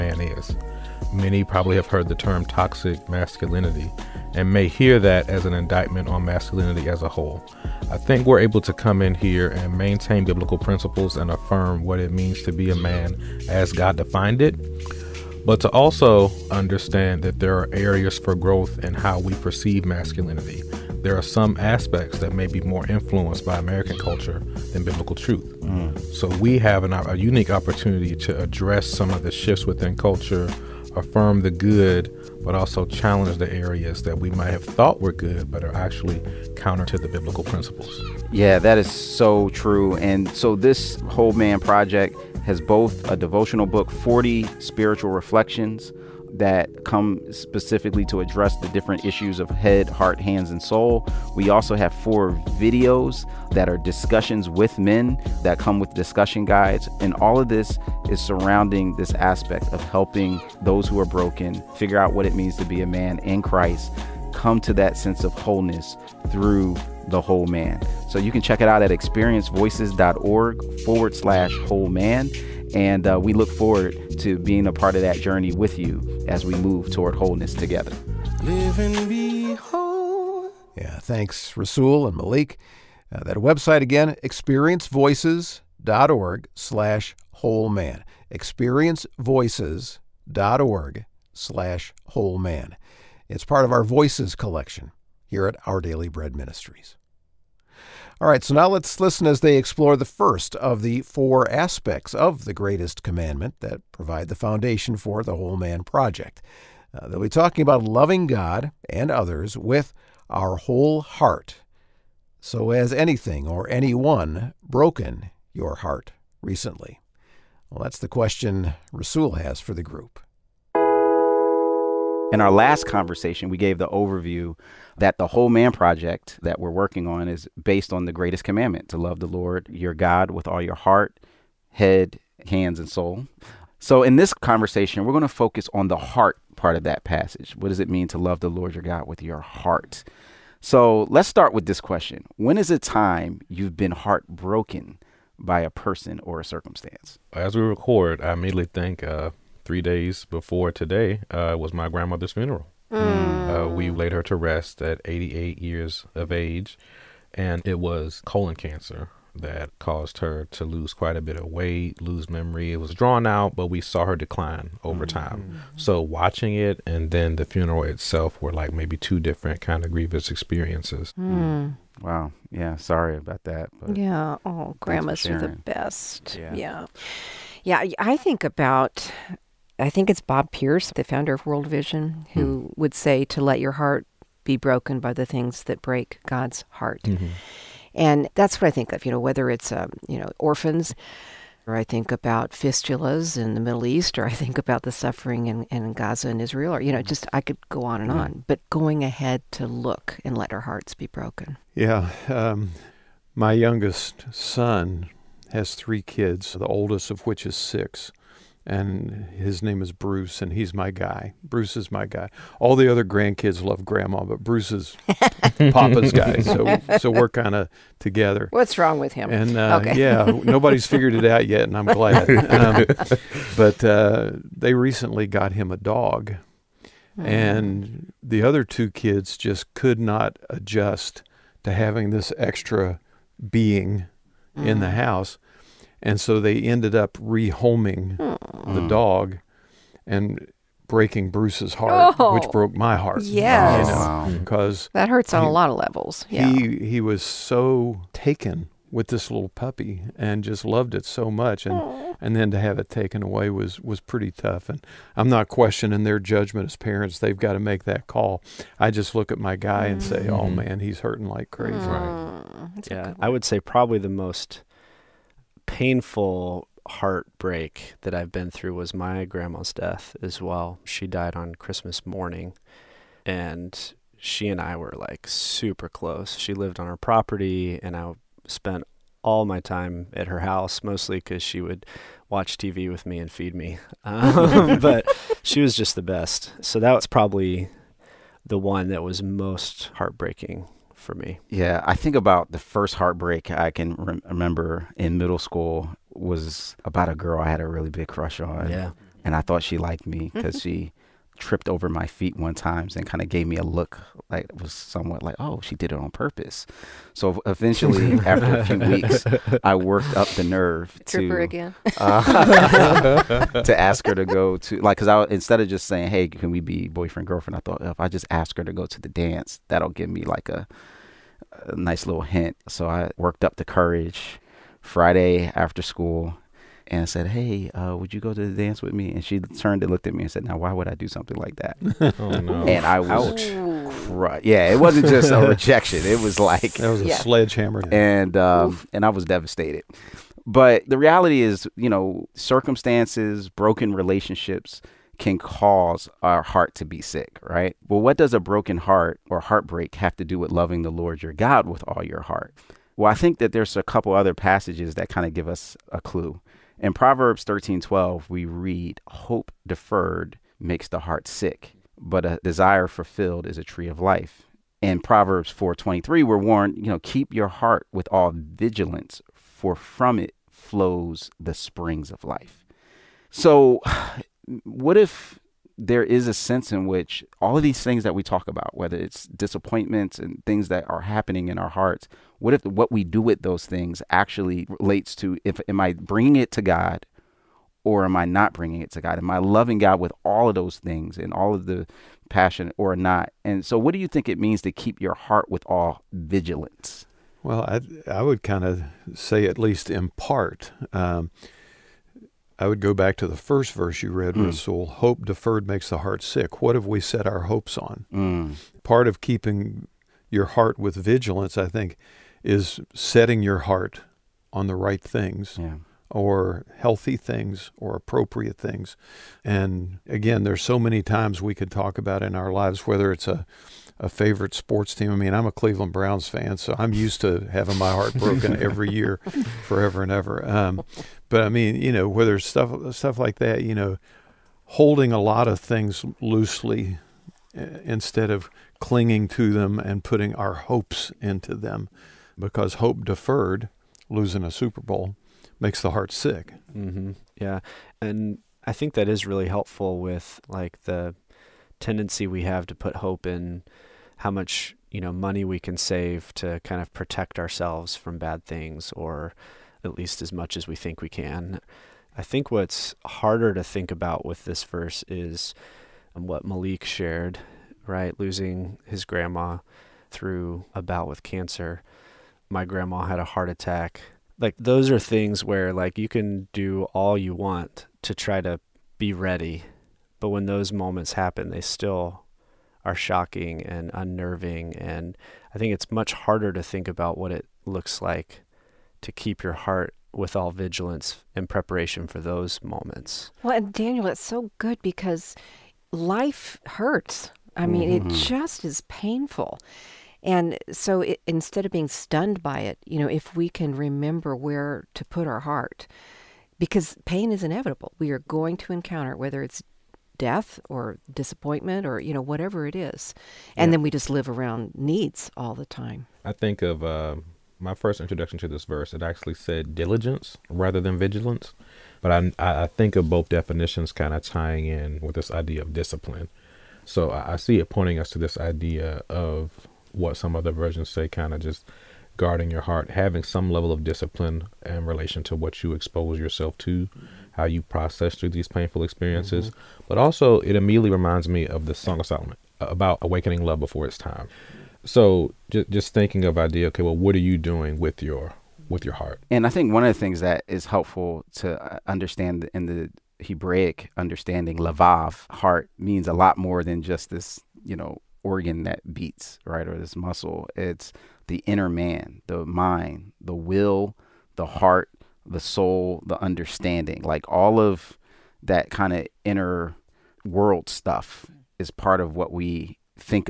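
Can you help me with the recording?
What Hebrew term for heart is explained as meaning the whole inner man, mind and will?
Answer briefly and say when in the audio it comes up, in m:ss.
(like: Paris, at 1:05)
lavav, at 9:14.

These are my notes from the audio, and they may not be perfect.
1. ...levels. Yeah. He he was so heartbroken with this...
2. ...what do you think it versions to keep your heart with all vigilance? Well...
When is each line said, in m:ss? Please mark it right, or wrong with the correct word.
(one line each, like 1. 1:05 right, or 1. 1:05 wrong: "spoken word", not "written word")
1. 4:05 wrong: "taken", not "heartbroken"
2. 6:33 wrong: "means", not "versions".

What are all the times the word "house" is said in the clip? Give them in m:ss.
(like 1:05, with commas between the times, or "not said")
3:54, 4:40.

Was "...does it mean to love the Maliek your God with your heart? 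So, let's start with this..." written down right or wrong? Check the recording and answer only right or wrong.
wrong.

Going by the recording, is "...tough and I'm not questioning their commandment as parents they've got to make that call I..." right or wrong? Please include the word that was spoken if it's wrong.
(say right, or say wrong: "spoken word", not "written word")
wrong: "judgment", not "commandment".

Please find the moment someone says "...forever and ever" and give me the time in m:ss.
7:09.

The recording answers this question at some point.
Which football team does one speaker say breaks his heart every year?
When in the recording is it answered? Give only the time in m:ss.
7:05.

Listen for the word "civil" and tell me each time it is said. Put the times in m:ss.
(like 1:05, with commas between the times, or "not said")
not said.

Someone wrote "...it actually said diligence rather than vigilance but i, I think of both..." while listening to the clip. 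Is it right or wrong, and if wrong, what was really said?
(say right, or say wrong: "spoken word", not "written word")
right.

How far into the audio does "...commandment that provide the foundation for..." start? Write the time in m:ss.
1:43.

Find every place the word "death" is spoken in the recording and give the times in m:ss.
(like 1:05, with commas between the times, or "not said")
4:29, 8:30.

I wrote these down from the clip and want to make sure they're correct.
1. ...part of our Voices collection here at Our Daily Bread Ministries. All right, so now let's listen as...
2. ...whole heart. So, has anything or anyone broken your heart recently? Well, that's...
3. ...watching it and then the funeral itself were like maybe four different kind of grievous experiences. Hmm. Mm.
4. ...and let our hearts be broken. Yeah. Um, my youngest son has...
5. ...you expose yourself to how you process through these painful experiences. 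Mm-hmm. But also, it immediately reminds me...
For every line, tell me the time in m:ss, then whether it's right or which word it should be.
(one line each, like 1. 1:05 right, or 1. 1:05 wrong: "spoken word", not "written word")
1. 1:33 right
2. 1:50 right
3. 2:46 wrong: "two", not "four"
4. 3:20 right
5. 8:55 right.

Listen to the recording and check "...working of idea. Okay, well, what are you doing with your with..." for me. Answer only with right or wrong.
wrong.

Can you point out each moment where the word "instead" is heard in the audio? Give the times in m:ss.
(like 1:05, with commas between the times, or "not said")
5:15, 7:17, 8:21.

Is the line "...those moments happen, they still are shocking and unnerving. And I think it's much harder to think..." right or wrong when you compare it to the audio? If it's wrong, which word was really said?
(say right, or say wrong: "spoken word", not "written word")
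right.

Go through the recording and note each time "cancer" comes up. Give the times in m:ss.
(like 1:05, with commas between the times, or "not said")
2:38, 7:51.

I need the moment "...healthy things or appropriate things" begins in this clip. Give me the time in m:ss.
6:56.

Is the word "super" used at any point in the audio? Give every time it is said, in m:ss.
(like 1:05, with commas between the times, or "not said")
4:35, 7:24.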